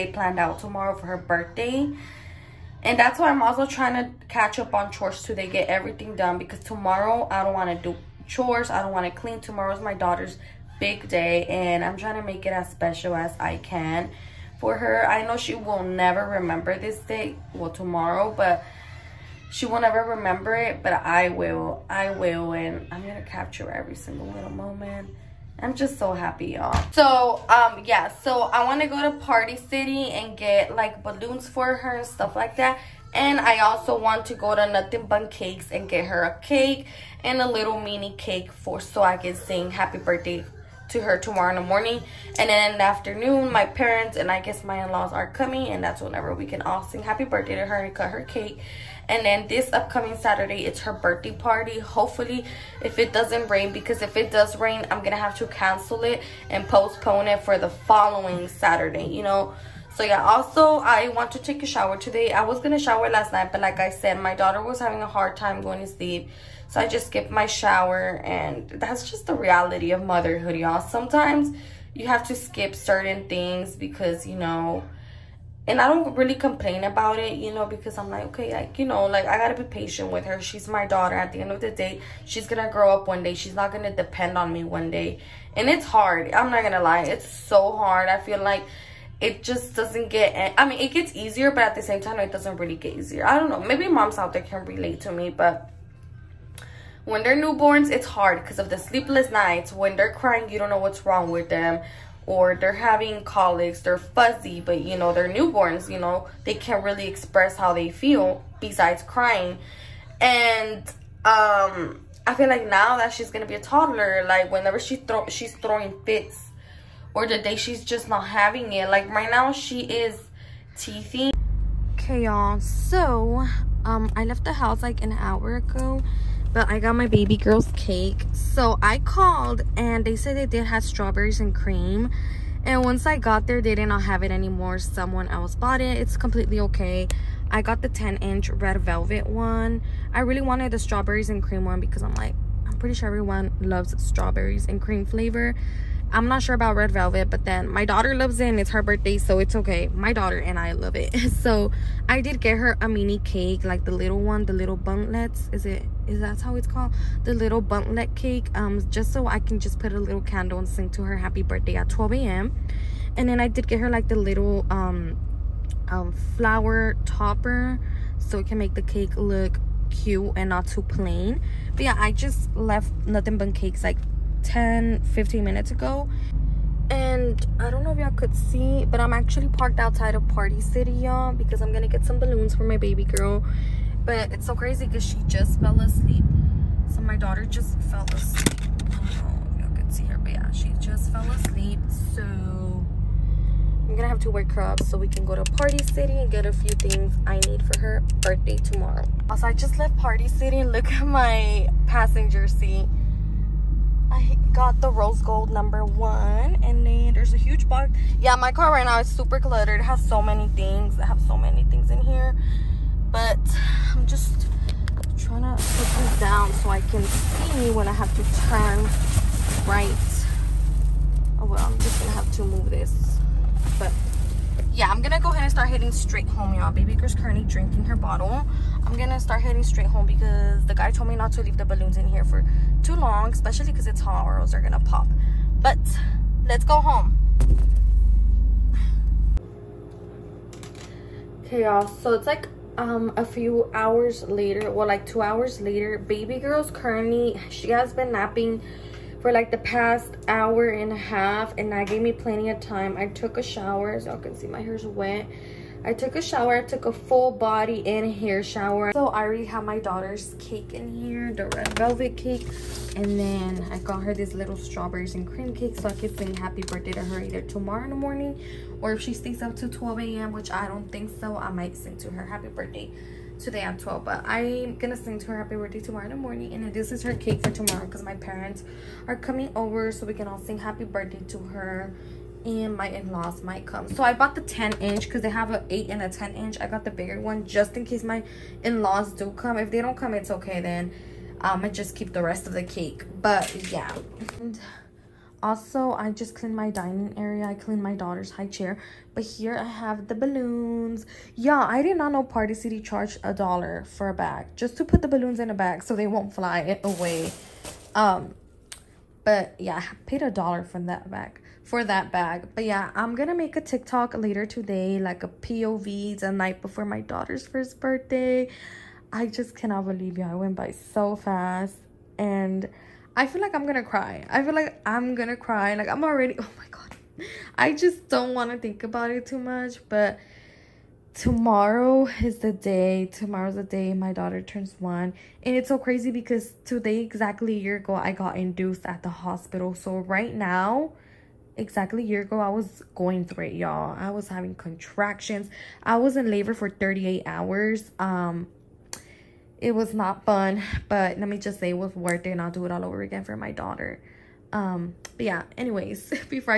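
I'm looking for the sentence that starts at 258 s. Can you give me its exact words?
So I already have my daughter's cake in here, the red velvet cake.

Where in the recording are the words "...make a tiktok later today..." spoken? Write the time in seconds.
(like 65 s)
313 s.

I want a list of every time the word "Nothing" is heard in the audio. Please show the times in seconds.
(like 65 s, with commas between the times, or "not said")
34 s, 173 s.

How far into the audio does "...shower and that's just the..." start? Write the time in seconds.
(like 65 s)
67 s.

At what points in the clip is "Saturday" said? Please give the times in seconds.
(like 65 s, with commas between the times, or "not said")
50 s, 58 s.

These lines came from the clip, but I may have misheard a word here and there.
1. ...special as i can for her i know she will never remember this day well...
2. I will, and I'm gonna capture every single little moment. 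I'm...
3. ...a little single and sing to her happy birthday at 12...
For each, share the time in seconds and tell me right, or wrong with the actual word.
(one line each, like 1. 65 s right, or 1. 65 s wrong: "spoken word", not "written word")
1. 12 s right
2. 21 s right
3. 159 s wrong: "candle", not "single".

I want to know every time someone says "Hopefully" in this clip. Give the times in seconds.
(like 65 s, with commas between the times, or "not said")
51 s.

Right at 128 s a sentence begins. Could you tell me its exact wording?
So I called and they said they did have strawberries and cream.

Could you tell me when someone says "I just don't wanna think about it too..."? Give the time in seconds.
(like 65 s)
327 s.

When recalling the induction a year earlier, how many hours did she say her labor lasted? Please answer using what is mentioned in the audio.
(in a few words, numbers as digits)
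38.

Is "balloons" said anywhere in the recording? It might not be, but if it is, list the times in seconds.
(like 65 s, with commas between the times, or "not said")
31 s, 182 s, 231 s, 300 s, 305 s.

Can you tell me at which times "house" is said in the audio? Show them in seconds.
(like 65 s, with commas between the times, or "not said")
124 s.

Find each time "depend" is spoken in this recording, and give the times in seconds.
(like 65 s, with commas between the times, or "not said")
83 s.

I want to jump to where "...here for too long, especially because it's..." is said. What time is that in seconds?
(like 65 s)
232 s.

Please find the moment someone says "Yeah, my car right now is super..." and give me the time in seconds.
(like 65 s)
208 s.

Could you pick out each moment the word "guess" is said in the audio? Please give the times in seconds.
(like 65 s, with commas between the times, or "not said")
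44 s.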